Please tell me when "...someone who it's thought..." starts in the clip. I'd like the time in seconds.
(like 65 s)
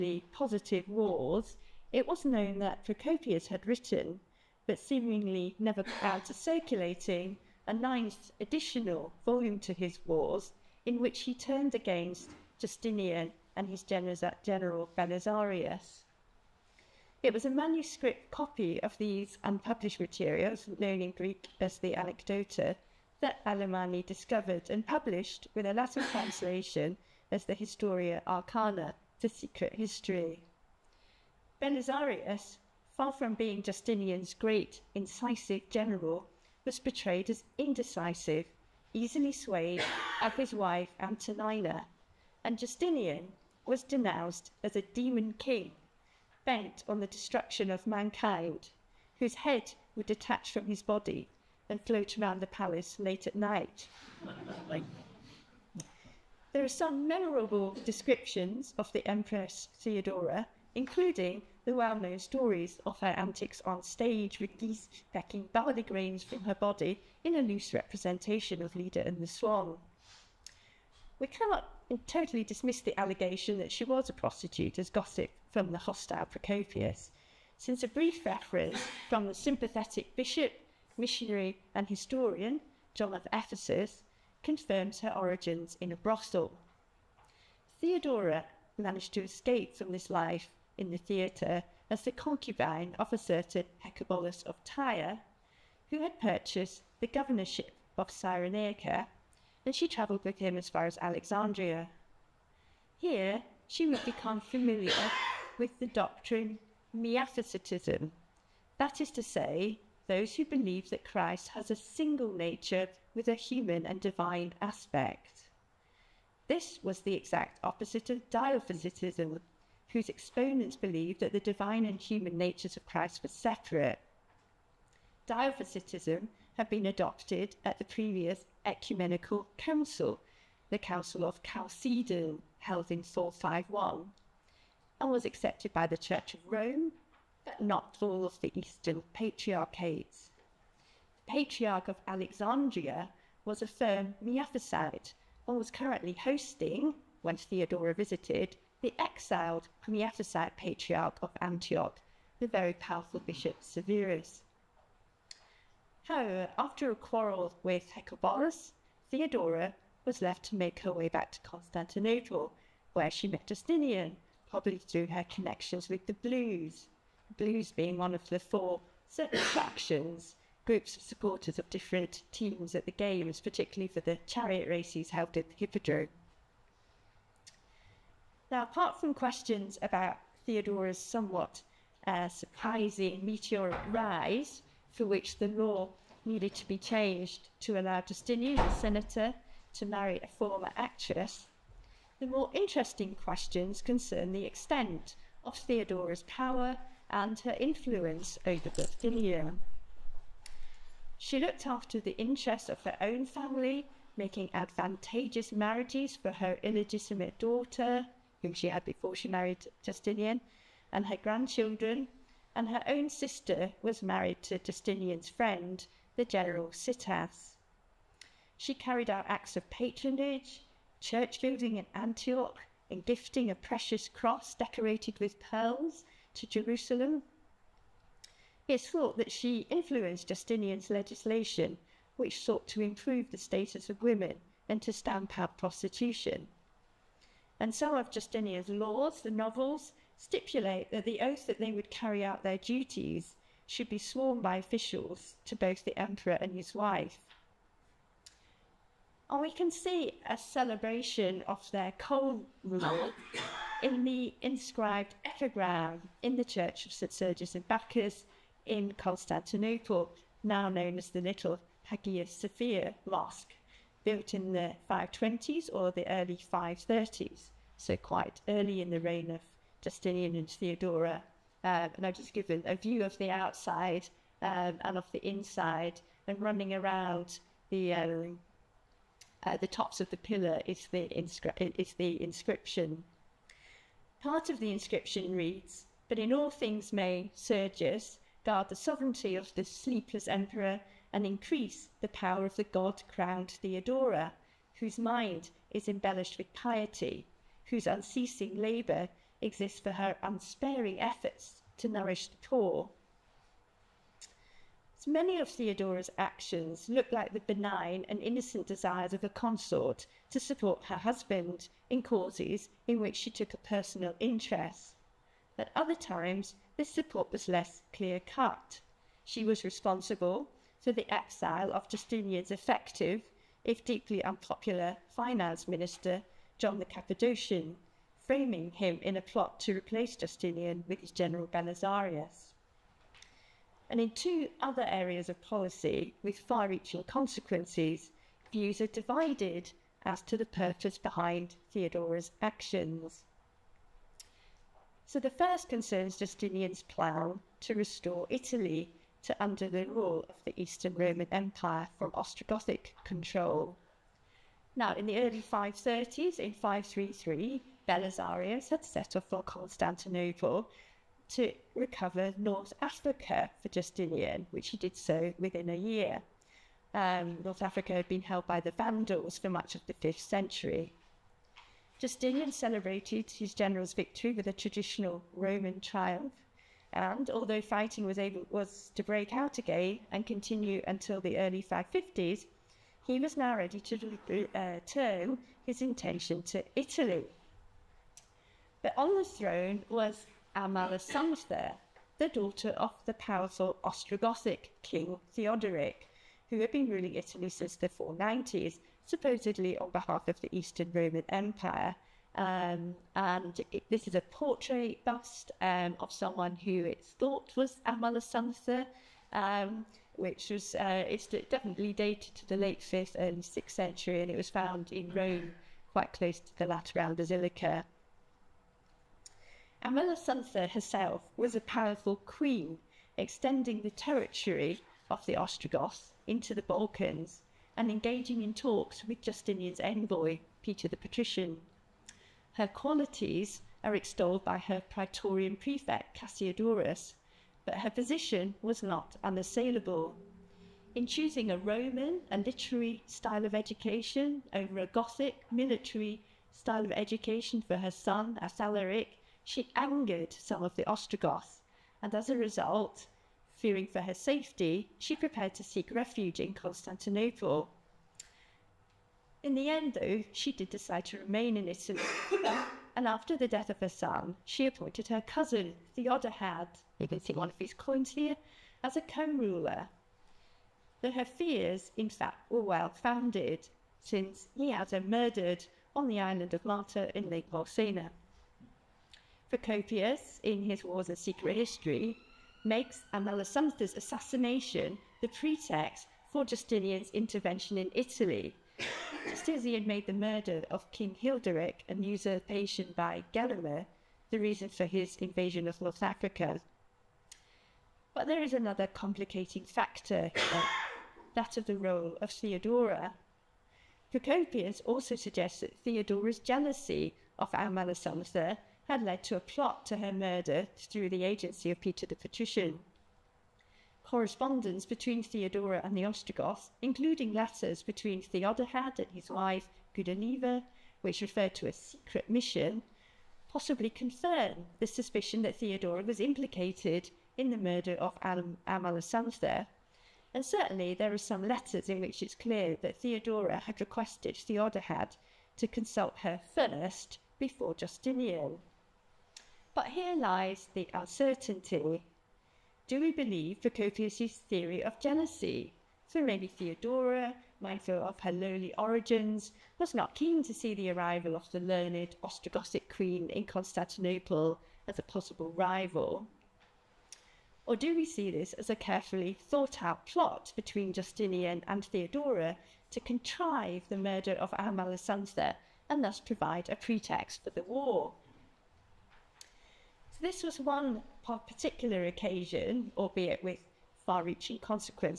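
406 s.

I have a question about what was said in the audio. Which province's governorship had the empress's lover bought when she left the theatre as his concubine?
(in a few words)
Cyrenaica.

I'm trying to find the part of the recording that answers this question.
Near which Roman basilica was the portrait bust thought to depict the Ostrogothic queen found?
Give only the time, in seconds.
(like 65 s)
416 s.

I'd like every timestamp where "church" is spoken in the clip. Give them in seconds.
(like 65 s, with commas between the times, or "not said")
135 s, 220 s, 256 s.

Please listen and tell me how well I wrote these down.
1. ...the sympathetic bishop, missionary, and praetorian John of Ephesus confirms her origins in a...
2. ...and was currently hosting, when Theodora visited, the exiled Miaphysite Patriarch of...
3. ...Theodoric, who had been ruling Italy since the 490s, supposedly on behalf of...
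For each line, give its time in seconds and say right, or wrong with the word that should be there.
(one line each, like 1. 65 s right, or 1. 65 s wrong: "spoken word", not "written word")
1. 79 s wrong: "historian", not "praetorian"
2. 145 s right
3. 395 s right.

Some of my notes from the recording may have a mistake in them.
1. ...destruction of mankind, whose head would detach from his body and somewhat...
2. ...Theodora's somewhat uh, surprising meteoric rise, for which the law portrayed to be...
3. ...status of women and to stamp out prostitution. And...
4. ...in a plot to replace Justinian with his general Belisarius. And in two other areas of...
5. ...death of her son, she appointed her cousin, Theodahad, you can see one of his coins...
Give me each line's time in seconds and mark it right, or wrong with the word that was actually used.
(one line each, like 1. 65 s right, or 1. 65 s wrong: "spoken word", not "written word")
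1. 47 s wrong: "float", not "somewhat"
2. 180 s wrong: "needed", not "portrayed"
3. 233 s right
4. 329 s right
5. 463 s right.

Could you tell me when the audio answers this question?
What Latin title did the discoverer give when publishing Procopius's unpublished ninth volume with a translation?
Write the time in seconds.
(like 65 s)
27 s.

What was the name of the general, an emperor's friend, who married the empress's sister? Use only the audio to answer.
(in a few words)
Sitas.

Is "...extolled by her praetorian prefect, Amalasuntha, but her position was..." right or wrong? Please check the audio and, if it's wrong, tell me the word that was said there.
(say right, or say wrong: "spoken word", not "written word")
wrong: "Cassiodorus", not "Amalasuntha".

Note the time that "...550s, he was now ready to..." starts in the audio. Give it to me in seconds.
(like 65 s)
381 s.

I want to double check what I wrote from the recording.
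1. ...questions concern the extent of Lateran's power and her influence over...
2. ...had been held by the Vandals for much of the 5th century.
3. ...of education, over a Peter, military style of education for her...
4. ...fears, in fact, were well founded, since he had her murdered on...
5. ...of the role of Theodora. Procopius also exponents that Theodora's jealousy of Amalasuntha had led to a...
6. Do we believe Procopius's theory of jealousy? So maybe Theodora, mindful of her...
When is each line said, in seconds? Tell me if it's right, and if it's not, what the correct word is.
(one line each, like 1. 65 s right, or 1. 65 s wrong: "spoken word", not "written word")
1. 193 s wrong: "Theodora", not "Lateran"
2. 367 s right
3. 443 s wrong: "Gothic", not "Peter"
4. 471 s right
5. 501 s wrong: "suggests", not "exponents"
6. 542 s right.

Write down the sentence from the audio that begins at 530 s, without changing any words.
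And certainly there are some letters in which it's clear that Theodora had requested Theodahad to consult her first before Justinian.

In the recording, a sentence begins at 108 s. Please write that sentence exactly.
That is to say, those who believe that Christ has a single nature with a human and divine aspect.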